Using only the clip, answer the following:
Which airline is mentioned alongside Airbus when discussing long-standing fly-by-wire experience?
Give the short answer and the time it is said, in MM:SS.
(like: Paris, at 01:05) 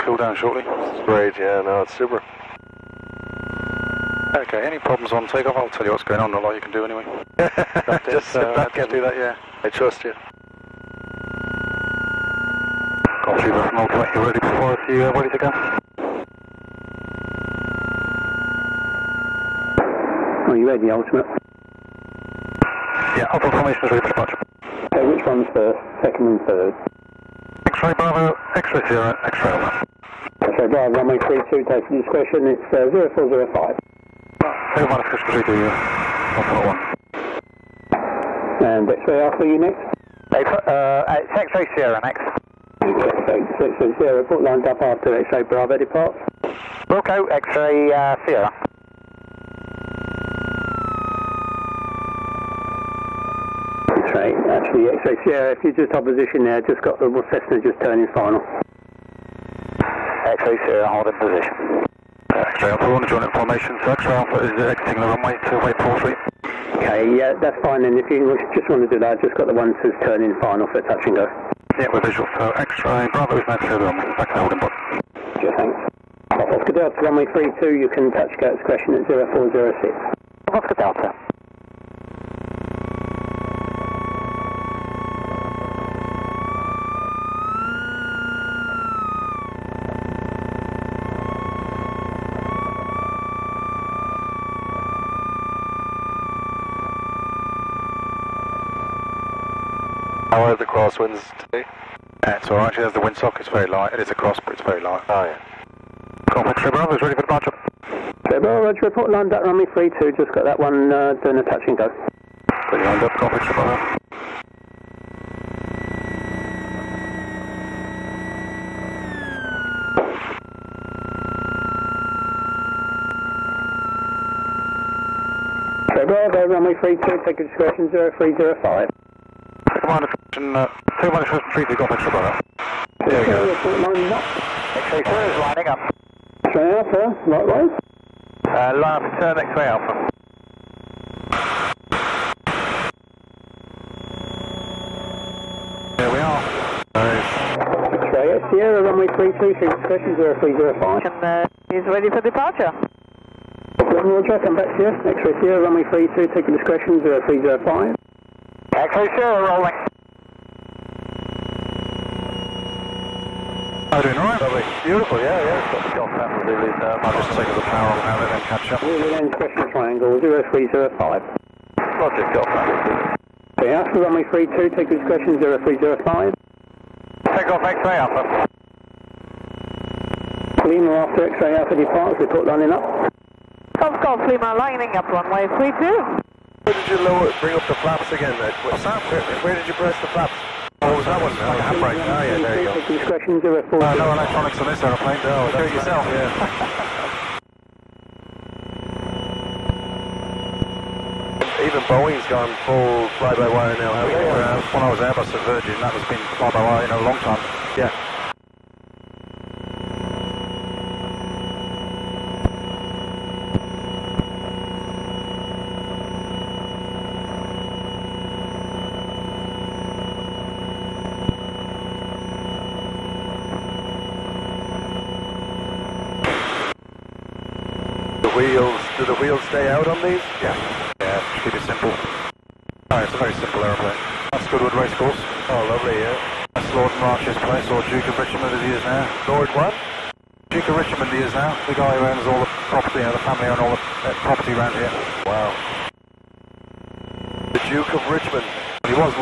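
Virgin, at 03:25.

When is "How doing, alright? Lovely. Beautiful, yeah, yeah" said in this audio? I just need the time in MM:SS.
02:43.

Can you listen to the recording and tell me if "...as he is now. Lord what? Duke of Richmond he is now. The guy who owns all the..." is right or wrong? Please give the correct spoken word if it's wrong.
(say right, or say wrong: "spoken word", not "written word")
right.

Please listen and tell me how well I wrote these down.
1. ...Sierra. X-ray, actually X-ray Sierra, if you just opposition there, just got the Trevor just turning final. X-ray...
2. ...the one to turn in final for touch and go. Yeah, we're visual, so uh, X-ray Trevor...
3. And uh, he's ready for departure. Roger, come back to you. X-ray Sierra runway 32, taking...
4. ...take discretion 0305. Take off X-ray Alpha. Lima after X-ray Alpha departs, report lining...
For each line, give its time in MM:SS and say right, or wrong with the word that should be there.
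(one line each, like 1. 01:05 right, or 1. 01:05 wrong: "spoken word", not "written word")
1. 00:48 wrong: "Cessna", not "Trevor"
2. 01:09 wrong: "Bravo", not "Trevor"
3. 02:31 right
4. 02:54 right.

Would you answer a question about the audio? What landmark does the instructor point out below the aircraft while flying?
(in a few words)
Goodwood Racecourse.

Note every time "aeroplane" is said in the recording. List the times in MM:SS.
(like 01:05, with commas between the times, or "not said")
03:14, 03:53.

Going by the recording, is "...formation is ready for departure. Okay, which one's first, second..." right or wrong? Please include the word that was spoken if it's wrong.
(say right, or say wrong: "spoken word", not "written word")
right.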